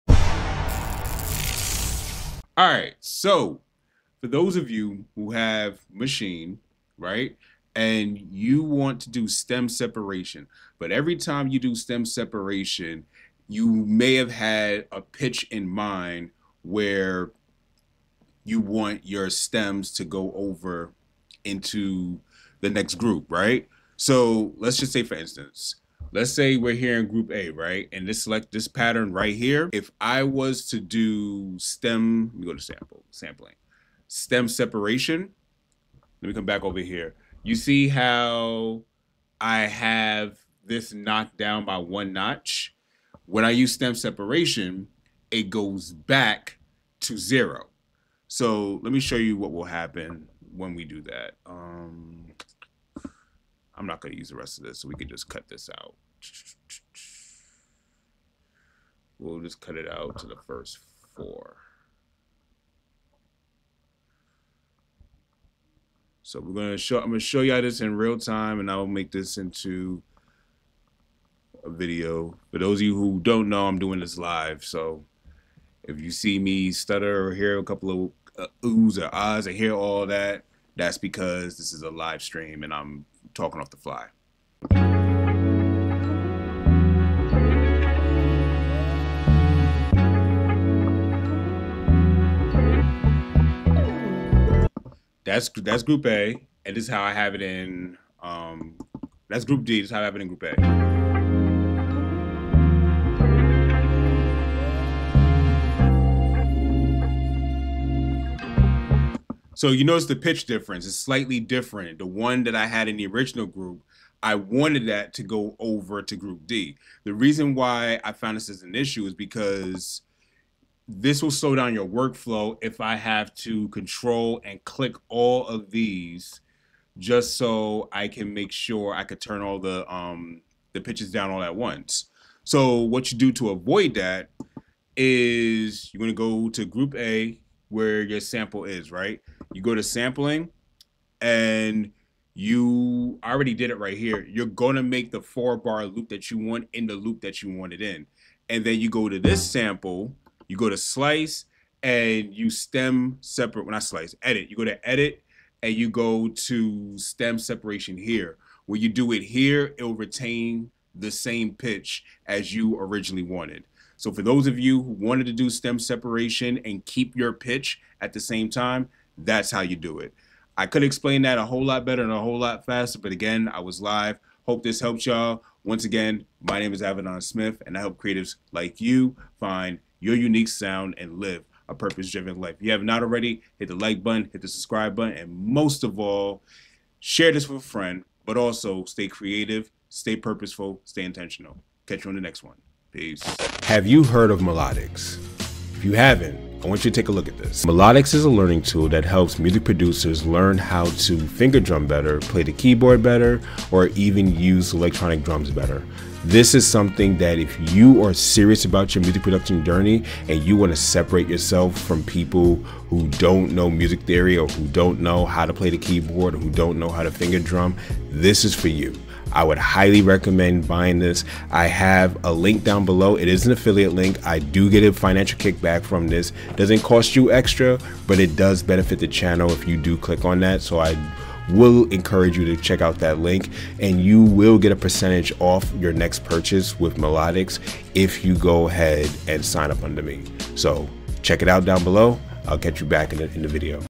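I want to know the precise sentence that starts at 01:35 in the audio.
That's that's group A, and this is how I have it in.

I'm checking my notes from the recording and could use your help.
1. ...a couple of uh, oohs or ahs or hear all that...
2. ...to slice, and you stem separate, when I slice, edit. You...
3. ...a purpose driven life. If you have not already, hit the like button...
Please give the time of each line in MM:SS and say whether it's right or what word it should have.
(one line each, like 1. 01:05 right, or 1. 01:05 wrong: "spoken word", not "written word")
1. 01:17 right
2. 02:30 right
3. 03:01 right.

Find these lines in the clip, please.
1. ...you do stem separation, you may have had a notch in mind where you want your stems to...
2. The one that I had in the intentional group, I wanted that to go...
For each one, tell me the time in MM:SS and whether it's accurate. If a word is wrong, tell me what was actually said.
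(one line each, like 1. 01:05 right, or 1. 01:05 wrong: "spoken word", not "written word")
1. 00:11 wrong: "pitch", not "notch"
2. 01:51 wrong: "original", not "intentional".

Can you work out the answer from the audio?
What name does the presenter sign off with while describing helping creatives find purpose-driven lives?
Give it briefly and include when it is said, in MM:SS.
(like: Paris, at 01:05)
Avidan Smith, at 02:56.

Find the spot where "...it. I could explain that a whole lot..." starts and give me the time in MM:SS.
02:49.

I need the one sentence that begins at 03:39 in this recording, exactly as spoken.
I would highly recommend buying this.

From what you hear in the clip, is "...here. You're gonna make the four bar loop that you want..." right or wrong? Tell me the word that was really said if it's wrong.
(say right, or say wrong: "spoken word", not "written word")
right.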